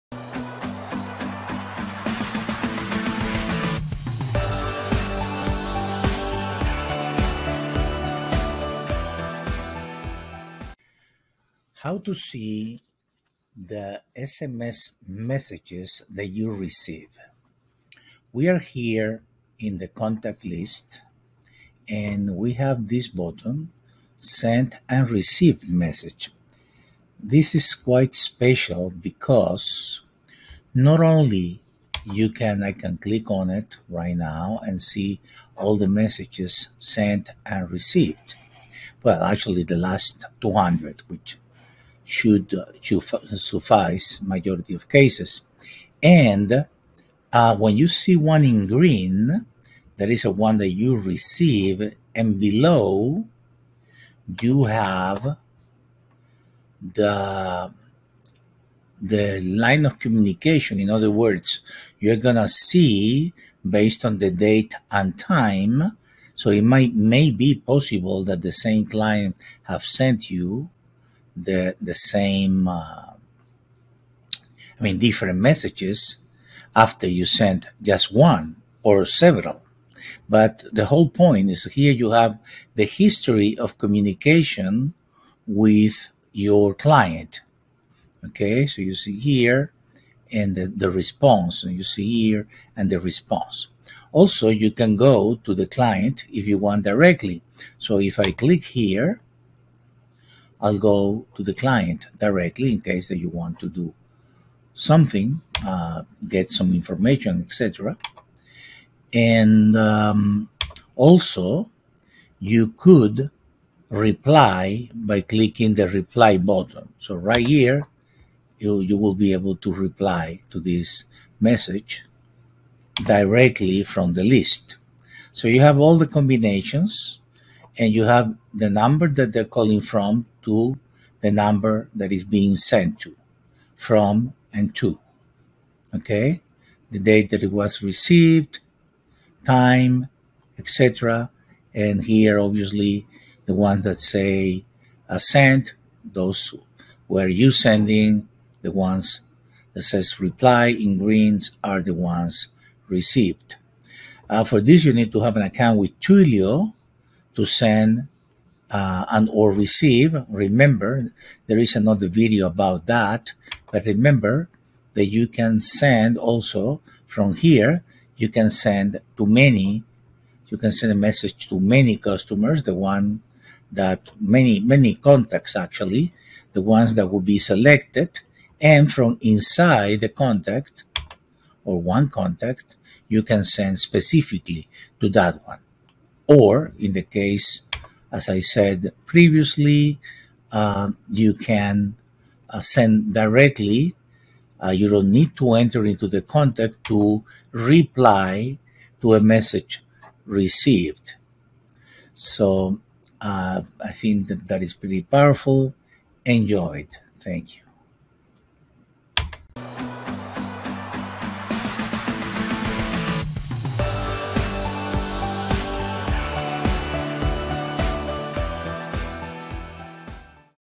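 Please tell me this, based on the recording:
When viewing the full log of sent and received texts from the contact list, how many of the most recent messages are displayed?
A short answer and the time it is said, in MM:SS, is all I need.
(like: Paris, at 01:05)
200, at 00:39.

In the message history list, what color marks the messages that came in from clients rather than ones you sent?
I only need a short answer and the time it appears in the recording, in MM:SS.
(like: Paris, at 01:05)
Green, at 00:48.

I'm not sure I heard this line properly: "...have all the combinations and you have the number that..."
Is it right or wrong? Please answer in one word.
right.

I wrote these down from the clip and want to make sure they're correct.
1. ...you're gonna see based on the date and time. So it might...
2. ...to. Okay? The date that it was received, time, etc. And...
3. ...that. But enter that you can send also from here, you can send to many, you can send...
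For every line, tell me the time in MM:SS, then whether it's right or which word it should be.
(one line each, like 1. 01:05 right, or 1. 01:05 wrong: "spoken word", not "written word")
1. 01:01 right
2. 02:14 right
3. 02:42 wrong: "remember", not "enter".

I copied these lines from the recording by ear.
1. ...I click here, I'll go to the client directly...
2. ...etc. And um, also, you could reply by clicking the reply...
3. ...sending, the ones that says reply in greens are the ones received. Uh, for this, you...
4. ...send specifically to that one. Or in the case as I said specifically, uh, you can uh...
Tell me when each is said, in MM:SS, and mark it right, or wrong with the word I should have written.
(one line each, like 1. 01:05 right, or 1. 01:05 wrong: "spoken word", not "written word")
1. 01:38 right
2. 01:47 right
3. 02:27 right
4. 03:03 wrong: "previously", not "specifically".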